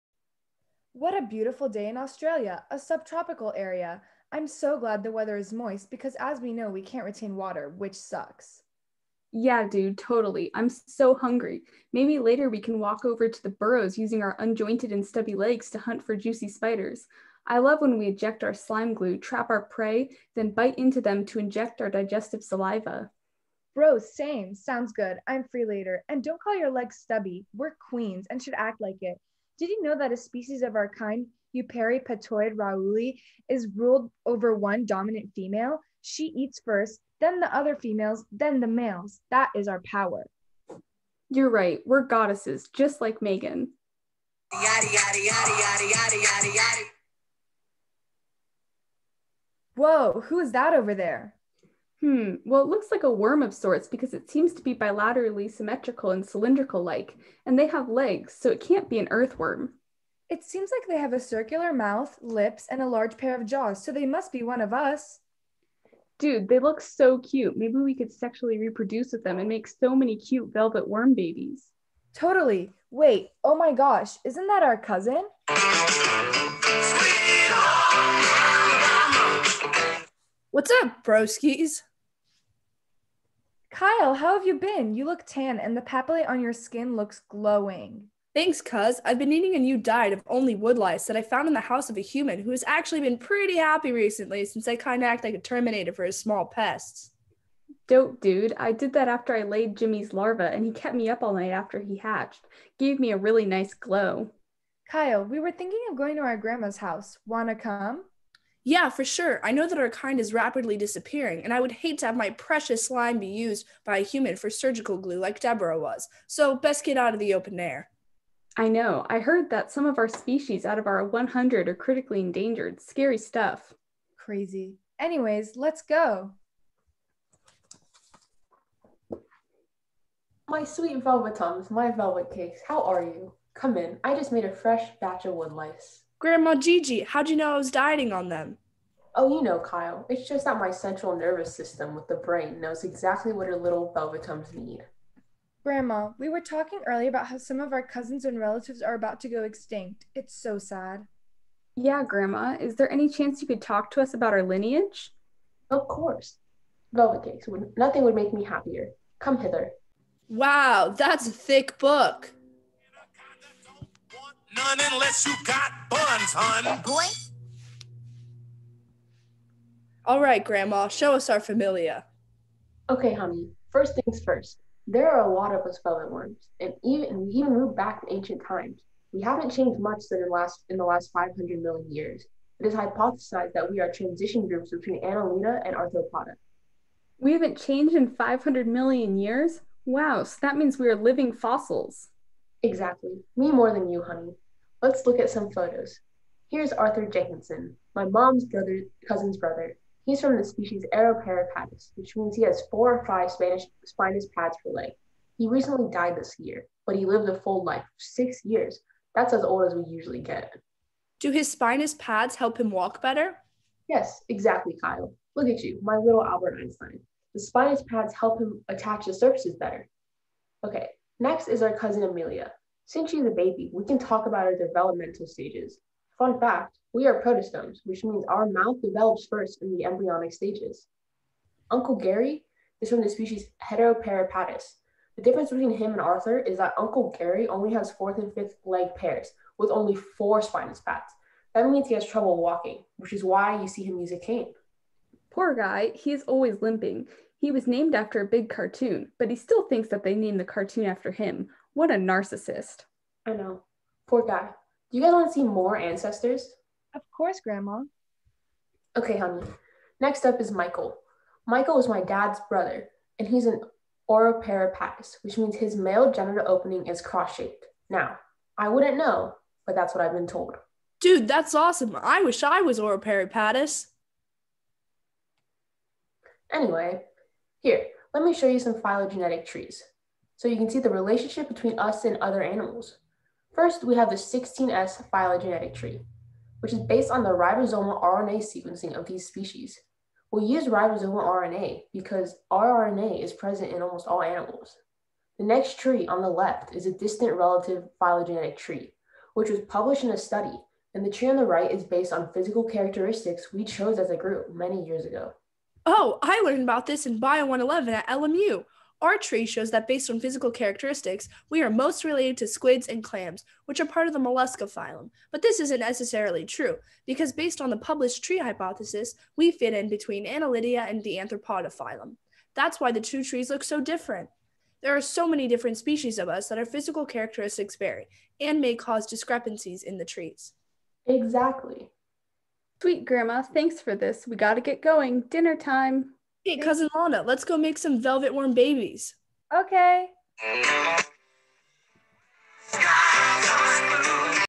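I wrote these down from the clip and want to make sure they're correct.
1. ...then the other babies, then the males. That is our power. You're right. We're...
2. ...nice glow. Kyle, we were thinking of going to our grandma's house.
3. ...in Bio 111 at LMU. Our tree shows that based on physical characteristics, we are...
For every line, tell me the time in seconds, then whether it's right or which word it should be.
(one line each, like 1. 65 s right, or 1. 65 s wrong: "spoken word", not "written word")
1. 37 s wrong: "females", not "babies"
2. 103 s right
3. 307 s right.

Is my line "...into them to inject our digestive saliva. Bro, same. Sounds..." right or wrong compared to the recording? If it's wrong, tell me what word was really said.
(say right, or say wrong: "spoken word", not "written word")
right.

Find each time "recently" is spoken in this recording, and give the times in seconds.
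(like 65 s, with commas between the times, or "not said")
93 s, 205 s.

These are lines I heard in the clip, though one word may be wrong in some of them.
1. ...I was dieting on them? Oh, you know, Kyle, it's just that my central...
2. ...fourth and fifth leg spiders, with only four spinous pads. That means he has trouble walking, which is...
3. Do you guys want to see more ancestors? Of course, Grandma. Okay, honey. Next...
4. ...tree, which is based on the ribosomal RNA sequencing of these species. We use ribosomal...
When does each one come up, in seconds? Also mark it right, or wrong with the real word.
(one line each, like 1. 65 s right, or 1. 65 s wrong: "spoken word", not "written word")
1. 137 s right
2. 237 s wrong: "pairs", not "spiders"
3. 254 s right
4. 285 s right.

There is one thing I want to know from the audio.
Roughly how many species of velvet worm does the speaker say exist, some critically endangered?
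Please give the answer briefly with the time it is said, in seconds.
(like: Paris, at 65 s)
100, at 121 s.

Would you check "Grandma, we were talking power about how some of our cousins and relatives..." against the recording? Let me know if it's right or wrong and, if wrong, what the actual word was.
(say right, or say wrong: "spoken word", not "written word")
wrong: "earlier", not "power".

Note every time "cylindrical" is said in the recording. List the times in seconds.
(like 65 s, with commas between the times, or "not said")
56 s.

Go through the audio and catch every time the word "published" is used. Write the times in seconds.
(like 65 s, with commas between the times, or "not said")
299 s, 317 s.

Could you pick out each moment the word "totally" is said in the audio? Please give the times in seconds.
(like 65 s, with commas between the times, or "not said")
9 s, 72 s.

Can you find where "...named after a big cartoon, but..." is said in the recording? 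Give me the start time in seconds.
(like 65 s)
247 s.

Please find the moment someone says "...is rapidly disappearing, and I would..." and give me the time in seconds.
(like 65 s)
110 s.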